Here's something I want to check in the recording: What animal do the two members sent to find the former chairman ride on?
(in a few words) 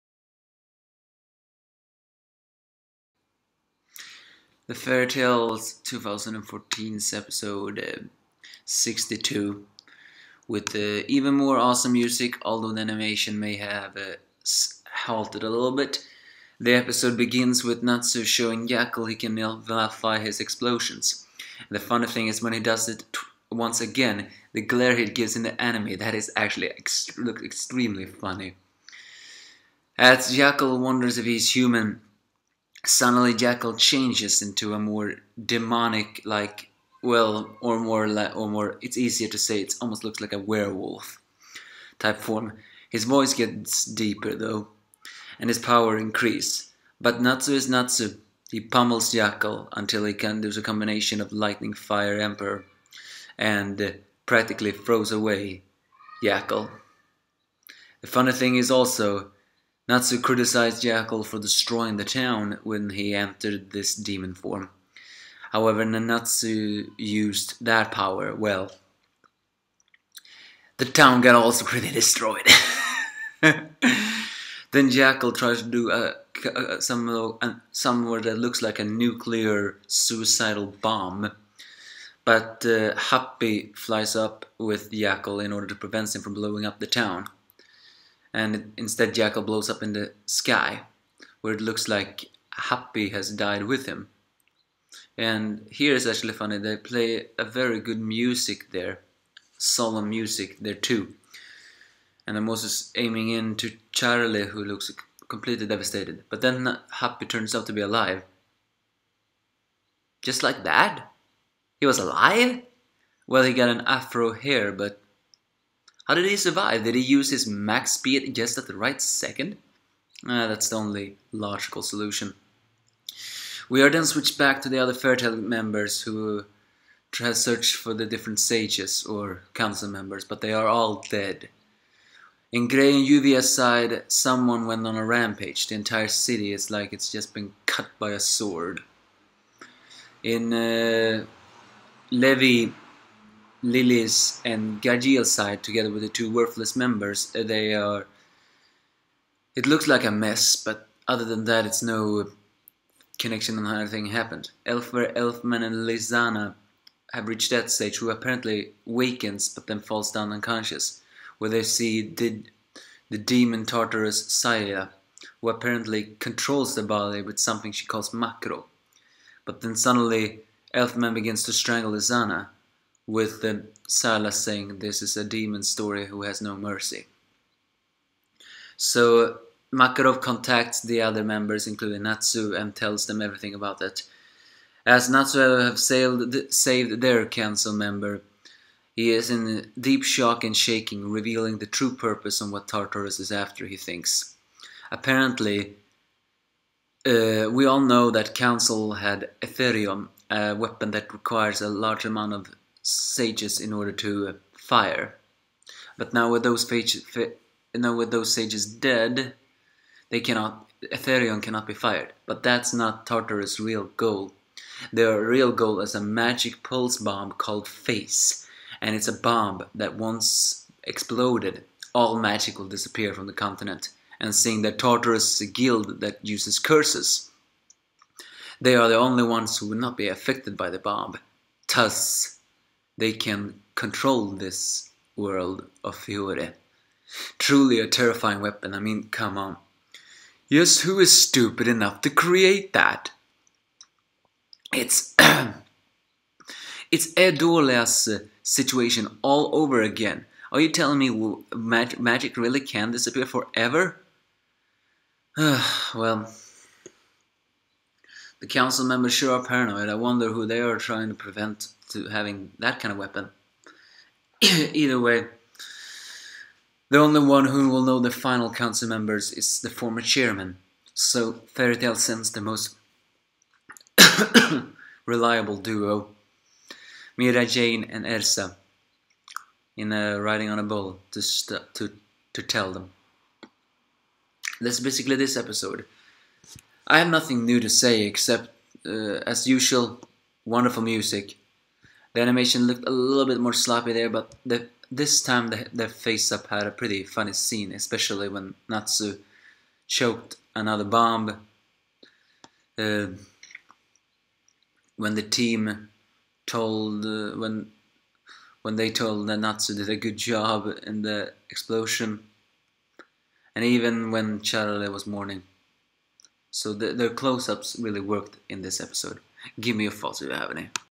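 a bull.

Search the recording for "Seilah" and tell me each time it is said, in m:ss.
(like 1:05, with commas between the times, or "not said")
2:44, 2:53.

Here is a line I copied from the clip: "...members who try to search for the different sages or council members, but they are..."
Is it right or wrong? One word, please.
right.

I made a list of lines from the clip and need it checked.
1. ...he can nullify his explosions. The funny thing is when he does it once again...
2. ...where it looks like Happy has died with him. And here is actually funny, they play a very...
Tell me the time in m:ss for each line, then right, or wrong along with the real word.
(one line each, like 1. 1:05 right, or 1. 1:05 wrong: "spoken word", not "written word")
1. 0:19 right
2. 1:31 right.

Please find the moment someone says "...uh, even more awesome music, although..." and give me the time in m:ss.
0:10.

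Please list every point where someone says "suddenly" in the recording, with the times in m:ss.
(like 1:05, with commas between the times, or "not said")
0:32, 2:49.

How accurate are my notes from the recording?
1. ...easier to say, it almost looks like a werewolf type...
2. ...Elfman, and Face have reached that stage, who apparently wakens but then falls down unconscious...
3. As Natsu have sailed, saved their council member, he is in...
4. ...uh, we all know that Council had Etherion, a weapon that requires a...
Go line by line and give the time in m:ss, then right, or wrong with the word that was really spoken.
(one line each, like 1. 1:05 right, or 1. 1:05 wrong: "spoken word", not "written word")
1. 0:38 right
2. 2:35 wrong: "Lisanna", not "Face"
3. 3:04 right
4. 3:17 right.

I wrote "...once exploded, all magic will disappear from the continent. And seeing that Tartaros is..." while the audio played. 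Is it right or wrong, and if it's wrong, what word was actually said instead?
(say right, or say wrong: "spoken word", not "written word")
right.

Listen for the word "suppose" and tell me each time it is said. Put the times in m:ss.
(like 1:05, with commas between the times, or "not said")
not said.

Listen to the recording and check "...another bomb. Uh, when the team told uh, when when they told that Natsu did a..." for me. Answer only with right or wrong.
right.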